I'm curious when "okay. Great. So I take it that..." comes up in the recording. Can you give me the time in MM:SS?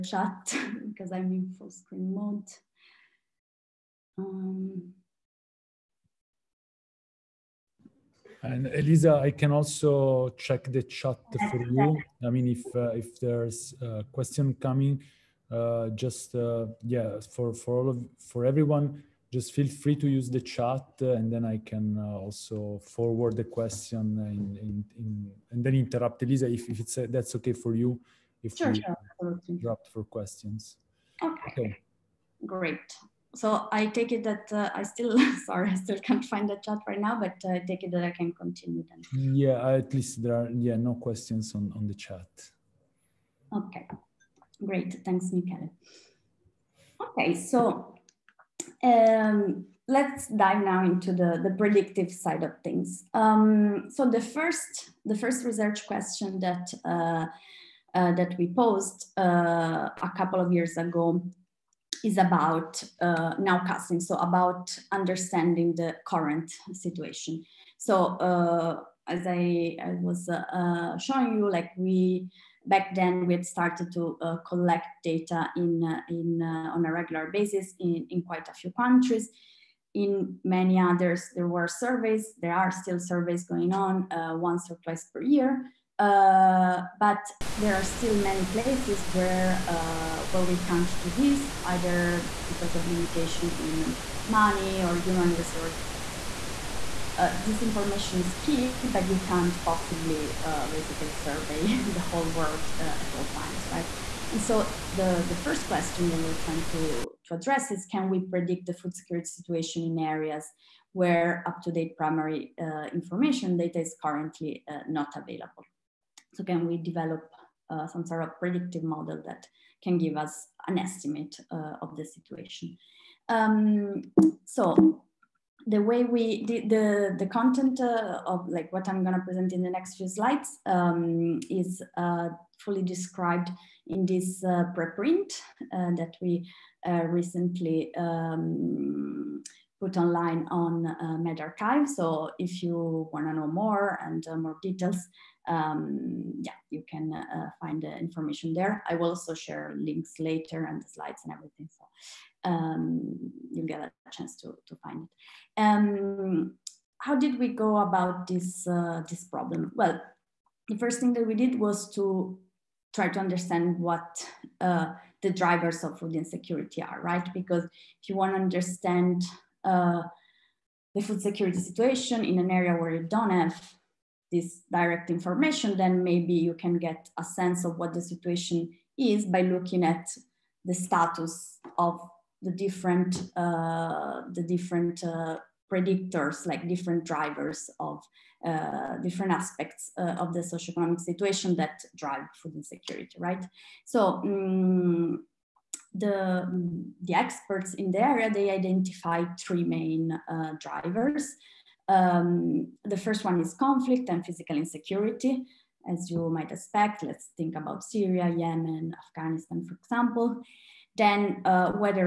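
00:31.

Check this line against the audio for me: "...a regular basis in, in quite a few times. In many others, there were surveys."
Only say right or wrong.
wrong.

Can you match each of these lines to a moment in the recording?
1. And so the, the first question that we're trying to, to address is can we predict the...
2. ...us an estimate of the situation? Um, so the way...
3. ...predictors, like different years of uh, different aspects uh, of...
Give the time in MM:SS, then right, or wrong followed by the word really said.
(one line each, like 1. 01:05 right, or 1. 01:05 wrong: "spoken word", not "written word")
1. 01:44 right
2. 02:00 right
3. 03:05 wrong: "drivers", not "years".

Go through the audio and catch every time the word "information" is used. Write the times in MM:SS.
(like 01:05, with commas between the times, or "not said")
01:37, 01:52, 02:27, 02:55.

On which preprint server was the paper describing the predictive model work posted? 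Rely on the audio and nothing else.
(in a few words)
medRxiv.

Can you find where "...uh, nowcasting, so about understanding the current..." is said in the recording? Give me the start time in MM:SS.
01:02.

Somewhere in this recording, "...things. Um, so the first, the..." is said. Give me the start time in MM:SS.
00:52.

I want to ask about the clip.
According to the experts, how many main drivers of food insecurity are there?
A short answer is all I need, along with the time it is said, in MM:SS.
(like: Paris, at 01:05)
3, at 03:19.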